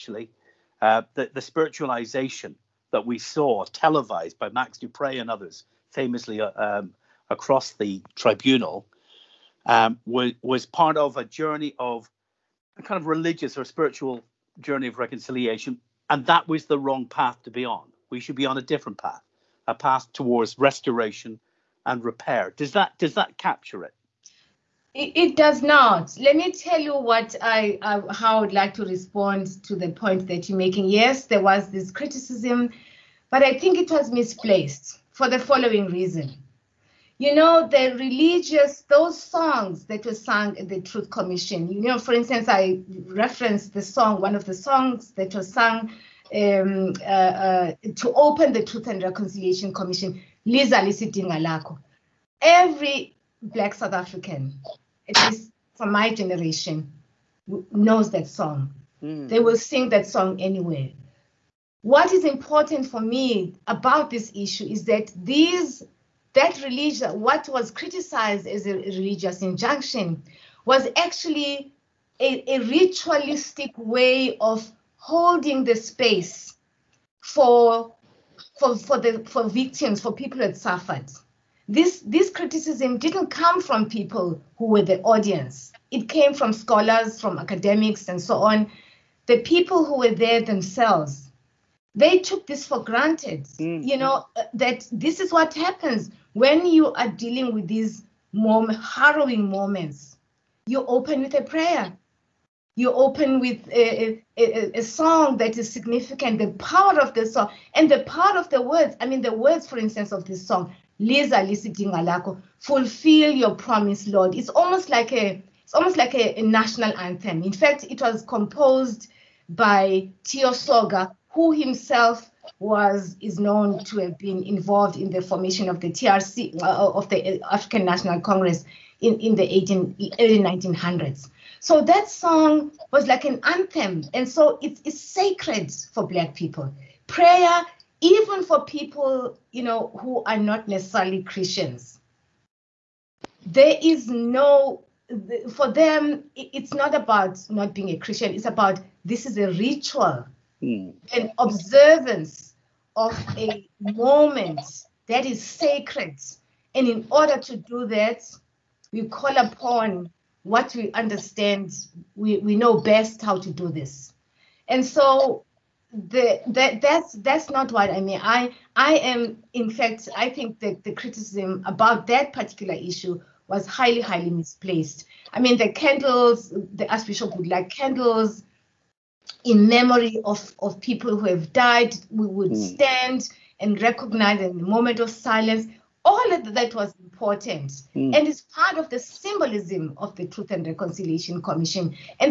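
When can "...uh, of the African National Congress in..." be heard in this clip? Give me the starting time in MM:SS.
02:06.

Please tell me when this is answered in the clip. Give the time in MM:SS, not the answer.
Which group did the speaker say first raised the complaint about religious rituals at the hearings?
01:26.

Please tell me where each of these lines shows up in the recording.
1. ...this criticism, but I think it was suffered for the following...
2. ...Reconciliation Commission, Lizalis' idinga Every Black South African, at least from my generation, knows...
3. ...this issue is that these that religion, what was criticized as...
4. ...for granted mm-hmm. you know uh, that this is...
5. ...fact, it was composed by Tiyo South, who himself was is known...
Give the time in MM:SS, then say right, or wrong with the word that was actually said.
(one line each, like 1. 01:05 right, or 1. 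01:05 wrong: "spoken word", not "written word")
1. 00:31 wrong: "misplaced", not "suffered"
2. 00:49 right
3. 01:04 right
4. 01:32 right
5. 01:57 wrong: "Soga", not "South".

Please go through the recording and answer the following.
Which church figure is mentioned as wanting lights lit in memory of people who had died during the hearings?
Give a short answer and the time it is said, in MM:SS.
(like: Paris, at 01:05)
The Archbishop, at 02:56.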